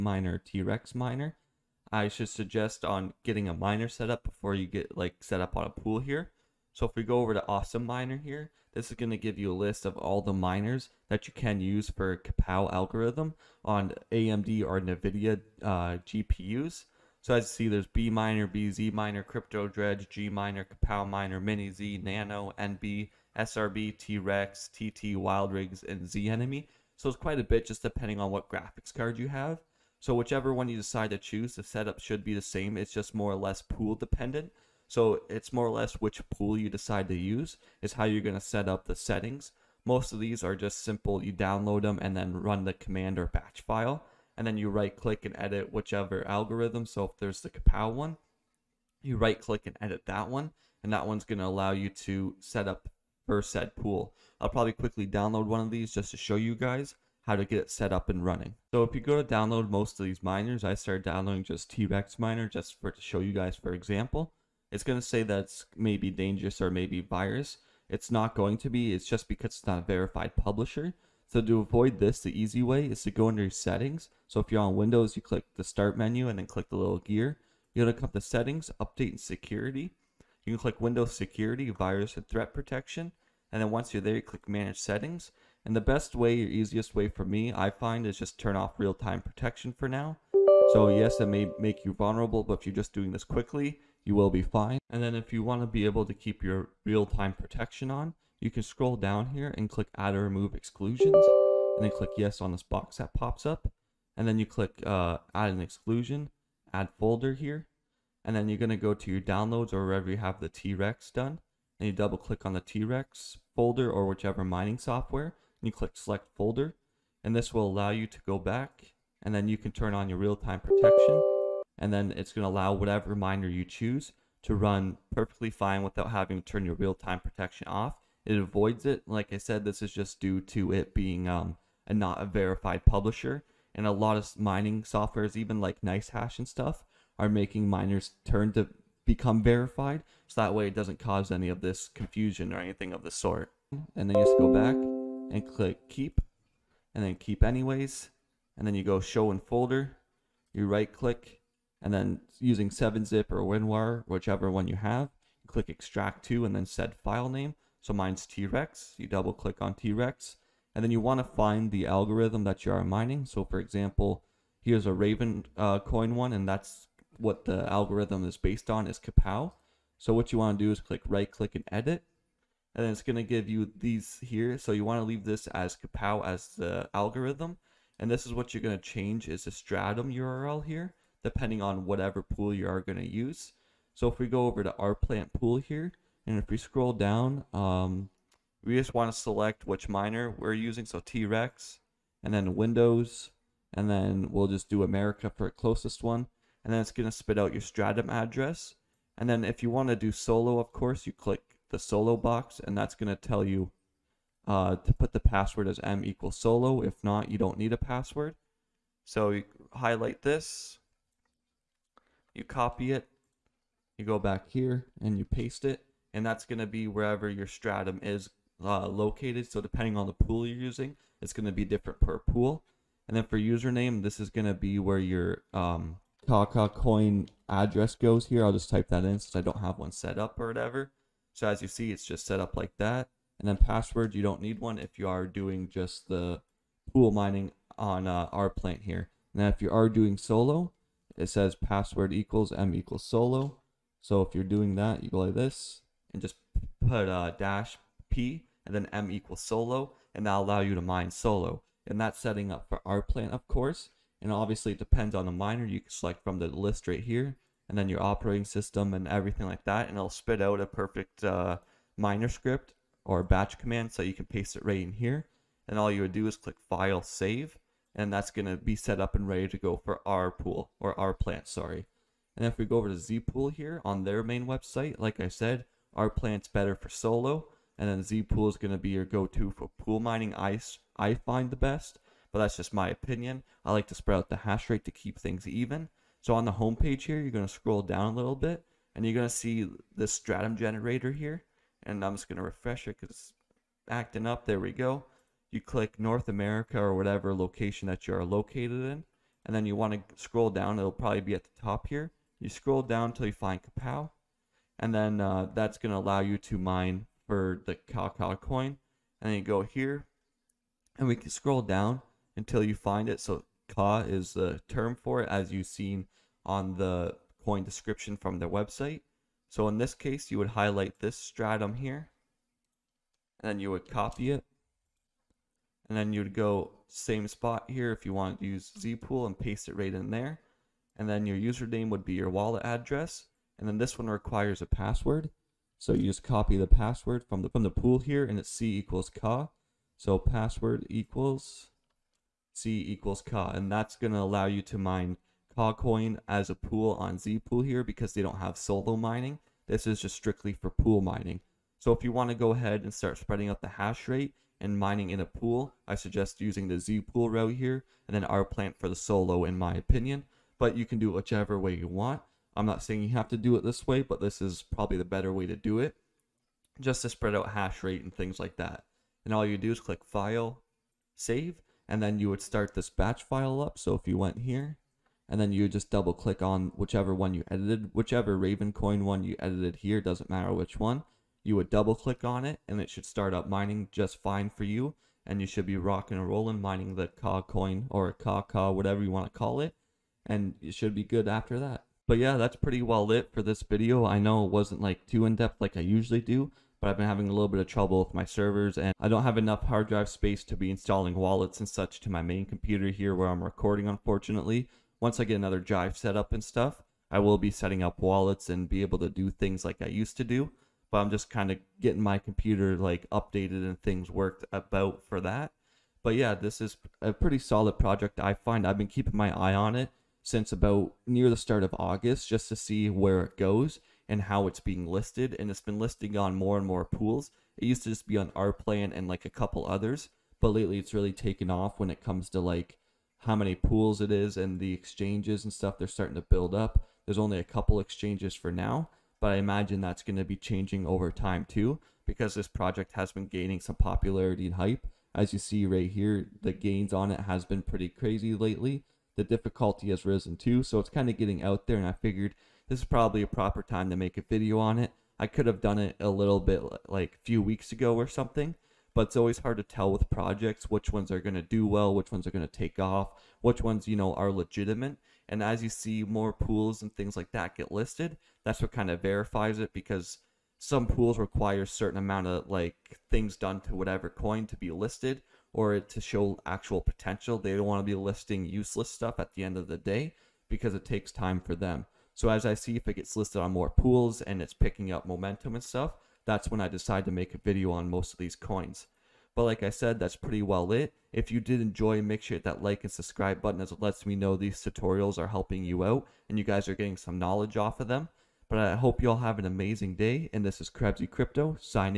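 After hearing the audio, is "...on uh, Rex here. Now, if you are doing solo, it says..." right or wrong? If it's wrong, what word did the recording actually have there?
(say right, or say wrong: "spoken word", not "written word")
wrong: "Rplant", not "Rex".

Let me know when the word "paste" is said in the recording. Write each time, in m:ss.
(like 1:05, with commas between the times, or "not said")
3:35, 4:24, 5:29.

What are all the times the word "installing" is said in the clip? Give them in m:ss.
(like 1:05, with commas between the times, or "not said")
6:40.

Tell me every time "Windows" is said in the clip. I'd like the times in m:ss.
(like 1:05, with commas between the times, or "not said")
1:14, 1:20, 3:12.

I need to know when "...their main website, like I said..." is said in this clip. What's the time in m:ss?
4:34.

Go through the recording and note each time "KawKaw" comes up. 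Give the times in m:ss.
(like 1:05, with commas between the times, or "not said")
3:46, 5:07, 6:28.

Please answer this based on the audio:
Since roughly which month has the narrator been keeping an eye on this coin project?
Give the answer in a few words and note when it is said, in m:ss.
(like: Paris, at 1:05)
August, at 7:01.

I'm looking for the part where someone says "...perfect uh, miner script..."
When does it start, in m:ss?
4:20.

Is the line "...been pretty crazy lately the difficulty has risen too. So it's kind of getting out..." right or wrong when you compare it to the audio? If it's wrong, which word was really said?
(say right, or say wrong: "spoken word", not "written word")
right.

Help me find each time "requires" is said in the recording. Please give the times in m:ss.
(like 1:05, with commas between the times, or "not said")
5:34, 7:51.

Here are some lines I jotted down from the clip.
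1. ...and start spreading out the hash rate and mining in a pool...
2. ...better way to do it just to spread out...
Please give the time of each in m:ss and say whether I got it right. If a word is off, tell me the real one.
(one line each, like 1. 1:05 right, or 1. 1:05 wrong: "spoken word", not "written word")
1. 5:52 right
2. 6:05 right.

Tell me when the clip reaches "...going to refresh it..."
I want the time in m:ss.
4:52.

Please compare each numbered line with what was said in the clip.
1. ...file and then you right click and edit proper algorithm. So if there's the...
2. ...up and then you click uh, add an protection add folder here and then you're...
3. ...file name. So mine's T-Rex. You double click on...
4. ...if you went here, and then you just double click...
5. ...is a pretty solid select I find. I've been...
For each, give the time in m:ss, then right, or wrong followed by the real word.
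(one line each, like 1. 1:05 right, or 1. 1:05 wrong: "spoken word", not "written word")
1. 0:43 wrong: "whichever", not "proper"
2. 1:43 wrong: "exclusion", not "protection"
3. 2:36 right
4. 6:13 right
5. 6:56 wrong: "project", not "select".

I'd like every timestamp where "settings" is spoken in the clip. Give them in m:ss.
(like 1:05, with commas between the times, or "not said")
0:38, 1:13, 1:18, 1:24, 4:12, 6:47.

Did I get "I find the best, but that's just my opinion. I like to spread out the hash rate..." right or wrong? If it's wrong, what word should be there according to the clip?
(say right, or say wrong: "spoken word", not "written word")
right.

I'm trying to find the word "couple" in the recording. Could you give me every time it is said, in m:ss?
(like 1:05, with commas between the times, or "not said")
7:09, 7:17.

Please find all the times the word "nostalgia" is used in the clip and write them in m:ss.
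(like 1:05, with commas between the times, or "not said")
not said.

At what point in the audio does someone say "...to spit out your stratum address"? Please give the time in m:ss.
3:17.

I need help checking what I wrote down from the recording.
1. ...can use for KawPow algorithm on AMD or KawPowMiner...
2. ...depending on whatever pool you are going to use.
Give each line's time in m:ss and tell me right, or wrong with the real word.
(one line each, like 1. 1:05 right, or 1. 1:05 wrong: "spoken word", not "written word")
1. 0:11 wrong: "NVIDIA", not "KawPowMiner"
2. 3:01 right.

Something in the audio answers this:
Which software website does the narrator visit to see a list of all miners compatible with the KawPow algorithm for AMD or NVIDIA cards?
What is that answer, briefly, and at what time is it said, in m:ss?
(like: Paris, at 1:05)
Awesome Miner, at 0:07.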